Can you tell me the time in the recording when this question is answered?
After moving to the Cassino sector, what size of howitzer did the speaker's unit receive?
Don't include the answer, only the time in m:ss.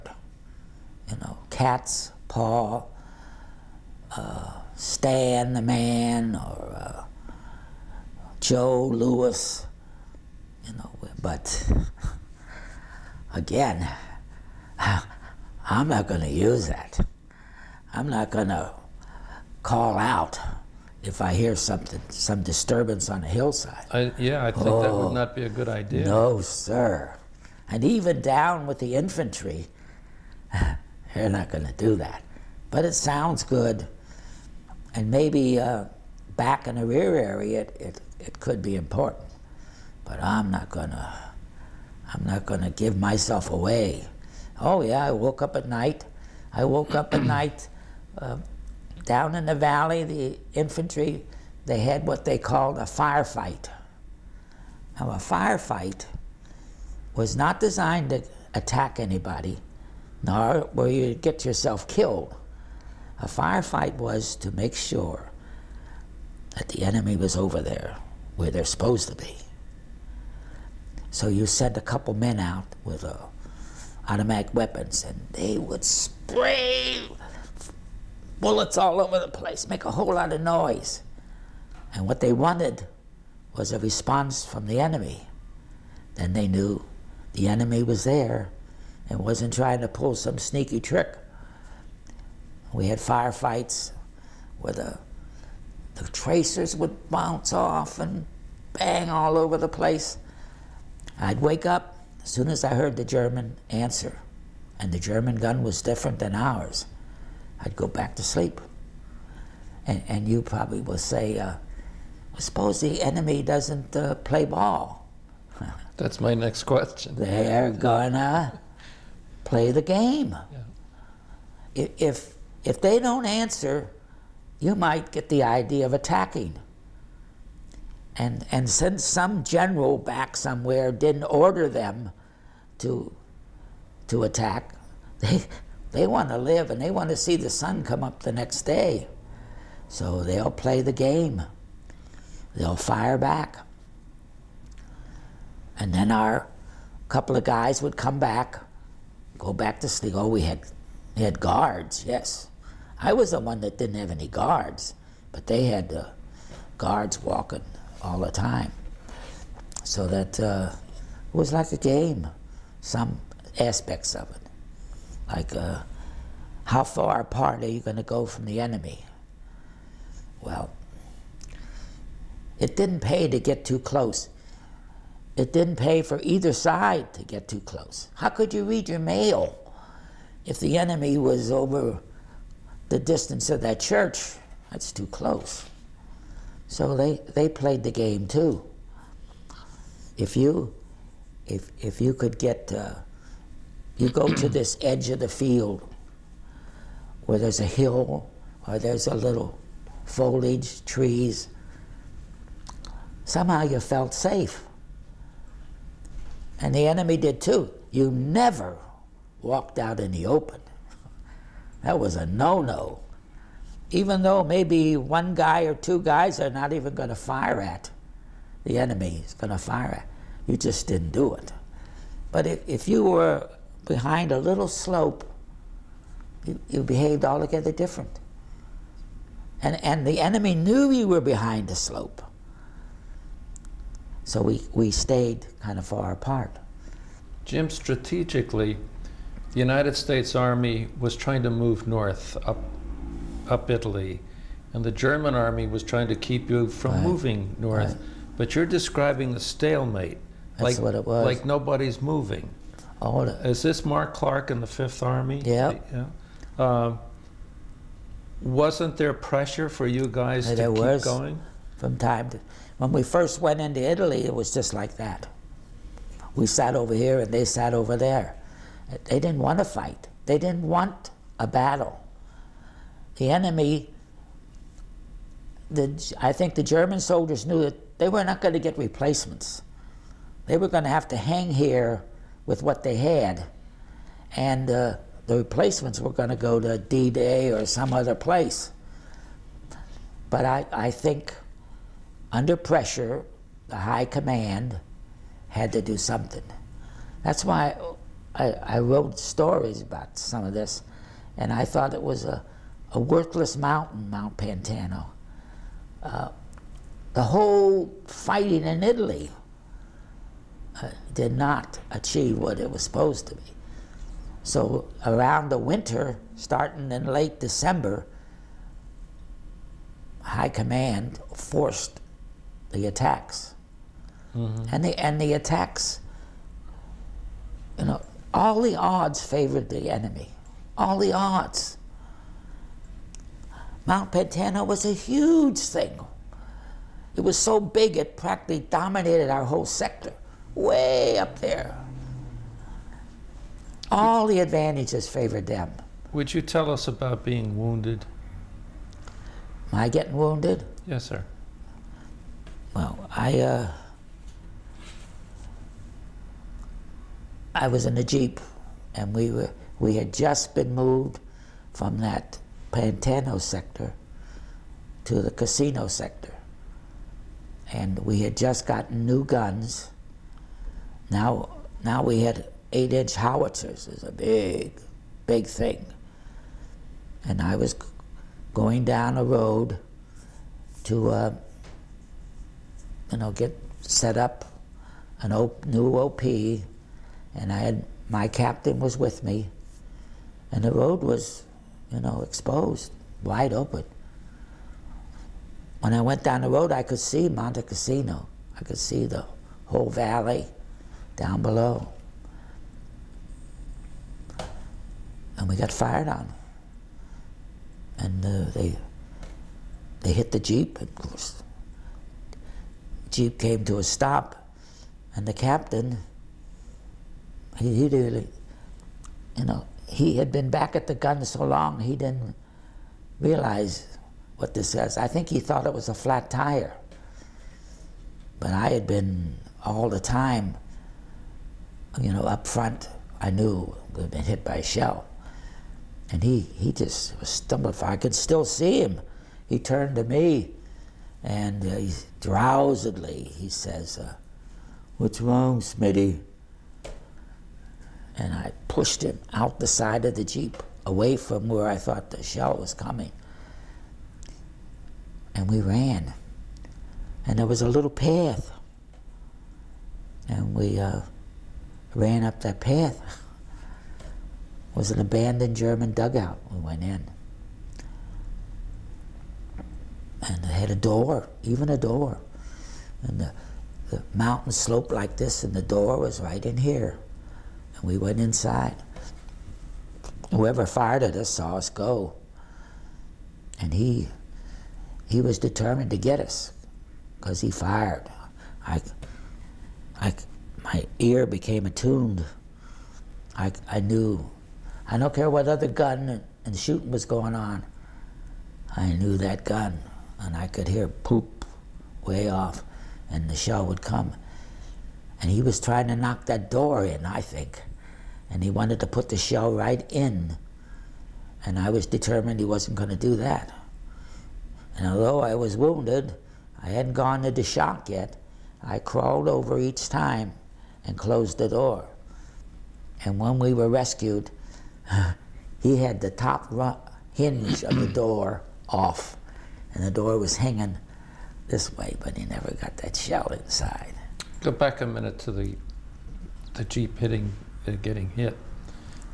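6:12.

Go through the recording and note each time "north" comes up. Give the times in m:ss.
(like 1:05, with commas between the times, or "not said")
4:01, 4:07.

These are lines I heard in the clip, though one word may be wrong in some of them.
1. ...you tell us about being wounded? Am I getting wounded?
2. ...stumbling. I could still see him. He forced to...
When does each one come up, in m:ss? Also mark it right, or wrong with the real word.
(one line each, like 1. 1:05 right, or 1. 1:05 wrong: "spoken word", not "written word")
1. 5:46 right
2. 7:17 wrong: "turned", not "forced".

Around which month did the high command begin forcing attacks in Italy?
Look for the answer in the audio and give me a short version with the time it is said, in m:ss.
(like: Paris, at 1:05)
December, at 5:17.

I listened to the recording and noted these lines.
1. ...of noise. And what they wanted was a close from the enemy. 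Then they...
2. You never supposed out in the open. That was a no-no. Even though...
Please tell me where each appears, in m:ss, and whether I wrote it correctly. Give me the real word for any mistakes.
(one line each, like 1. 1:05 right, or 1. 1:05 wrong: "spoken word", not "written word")
1. 1:20 wrong: "response", not "close"
2. 3:27 wrong: "walked", not "supposed".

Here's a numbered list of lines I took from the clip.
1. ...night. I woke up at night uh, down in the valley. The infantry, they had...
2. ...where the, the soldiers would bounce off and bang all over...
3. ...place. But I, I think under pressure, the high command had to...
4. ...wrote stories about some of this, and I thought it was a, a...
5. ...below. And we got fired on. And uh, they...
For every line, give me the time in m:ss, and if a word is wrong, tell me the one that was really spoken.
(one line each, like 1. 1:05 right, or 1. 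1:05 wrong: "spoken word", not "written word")
1. 0:45 right
2. 1:34 wrong: "tracers", not "soldiers"
3. 4:48 right
4. 4:58 right
5. 6:41 right.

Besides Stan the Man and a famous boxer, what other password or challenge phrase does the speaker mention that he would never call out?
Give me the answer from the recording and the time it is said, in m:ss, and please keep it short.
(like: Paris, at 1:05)
cat's paw, at 0:01.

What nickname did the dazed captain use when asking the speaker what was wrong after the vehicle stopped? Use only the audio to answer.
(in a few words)
Smitty.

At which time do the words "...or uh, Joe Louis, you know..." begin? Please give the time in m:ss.
0:06.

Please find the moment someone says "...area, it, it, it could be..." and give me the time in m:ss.
0:37.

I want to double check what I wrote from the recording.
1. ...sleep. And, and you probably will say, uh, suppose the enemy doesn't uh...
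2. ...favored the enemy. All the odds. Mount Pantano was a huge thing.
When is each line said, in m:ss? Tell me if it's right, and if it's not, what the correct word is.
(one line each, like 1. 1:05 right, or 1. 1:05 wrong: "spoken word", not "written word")
1. 1:48 right
2. 5:29 right.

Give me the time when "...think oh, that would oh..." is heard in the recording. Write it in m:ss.
0:24.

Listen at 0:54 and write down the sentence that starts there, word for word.
Now a firefight was not designed to attack anybody, nor where you get yourself killed.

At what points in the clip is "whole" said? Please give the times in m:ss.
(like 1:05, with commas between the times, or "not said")
1:19, 5:07, 5:39, 6:39.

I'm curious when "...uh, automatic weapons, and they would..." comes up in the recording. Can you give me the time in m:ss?
1:13.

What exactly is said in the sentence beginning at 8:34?
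And although I was wounded, I hadn't gone into shock yet, I crawled over each time and closed the door.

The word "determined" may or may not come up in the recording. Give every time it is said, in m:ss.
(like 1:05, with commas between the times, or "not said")
8:05, 8:31.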